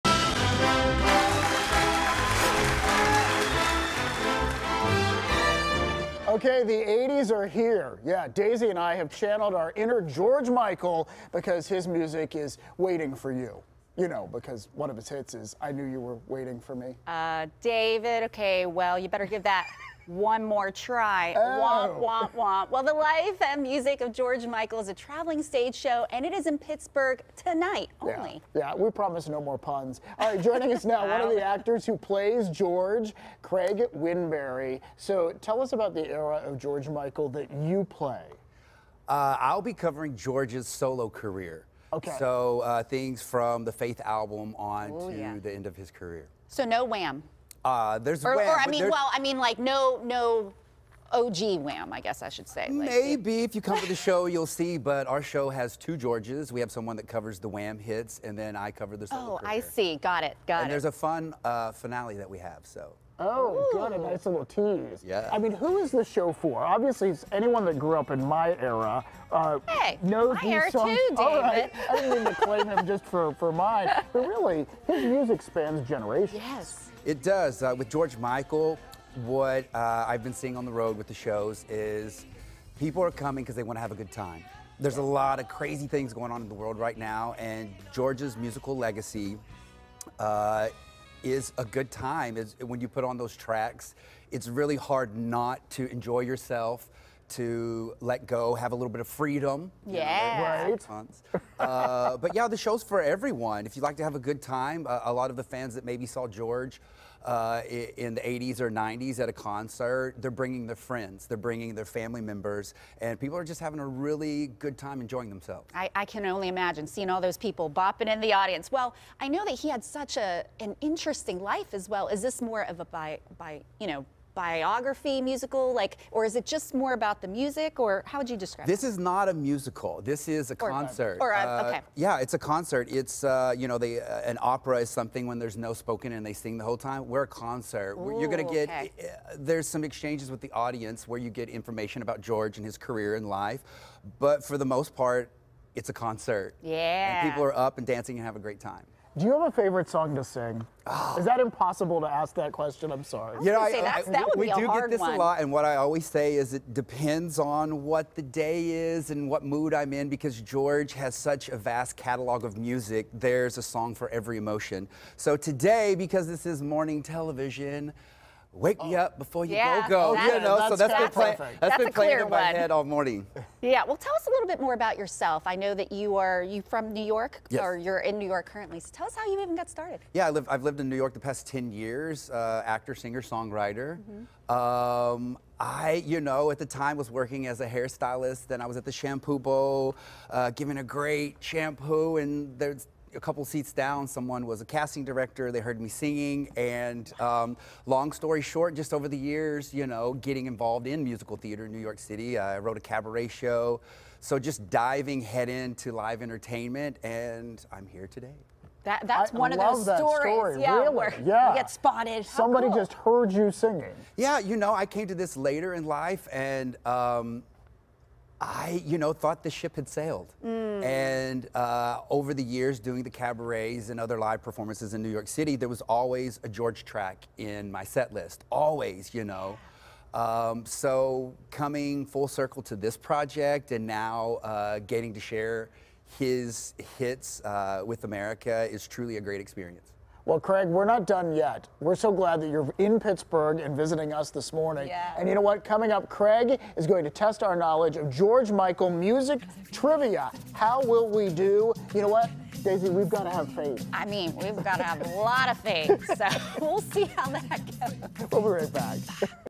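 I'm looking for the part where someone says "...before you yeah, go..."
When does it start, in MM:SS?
02:49.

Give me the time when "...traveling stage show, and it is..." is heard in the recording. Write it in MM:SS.
00:24.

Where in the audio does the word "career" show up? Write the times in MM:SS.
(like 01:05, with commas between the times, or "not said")
00:41, 00:45, 00:59, 02:22.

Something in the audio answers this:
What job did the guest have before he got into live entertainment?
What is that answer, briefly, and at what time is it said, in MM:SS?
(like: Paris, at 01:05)
Hairstylist, at 03:07.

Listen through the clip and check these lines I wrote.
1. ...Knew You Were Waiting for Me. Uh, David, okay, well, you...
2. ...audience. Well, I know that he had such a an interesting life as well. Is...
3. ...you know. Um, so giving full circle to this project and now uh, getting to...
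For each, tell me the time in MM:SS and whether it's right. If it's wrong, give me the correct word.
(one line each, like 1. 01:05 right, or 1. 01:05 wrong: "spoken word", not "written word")
1. 00:15 right
2. 01:58 right
3. 03:49 wrong: "coming", not "giving".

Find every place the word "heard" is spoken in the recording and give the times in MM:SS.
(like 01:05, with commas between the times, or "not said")
03:15, 03:32.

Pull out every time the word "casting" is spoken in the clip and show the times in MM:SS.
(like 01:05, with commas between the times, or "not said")
03:14.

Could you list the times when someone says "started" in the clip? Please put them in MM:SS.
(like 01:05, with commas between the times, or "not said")
02:59.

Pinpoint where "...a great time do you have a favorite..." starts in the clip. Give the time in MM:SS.
02:28.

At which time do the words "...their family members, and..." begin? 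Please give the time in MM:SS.
01:51.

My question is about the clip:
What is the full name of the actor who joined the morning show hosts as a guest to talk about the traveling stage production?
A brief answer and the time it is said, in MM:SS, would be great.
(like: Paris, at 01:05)
Craig Winberry, at 00:33.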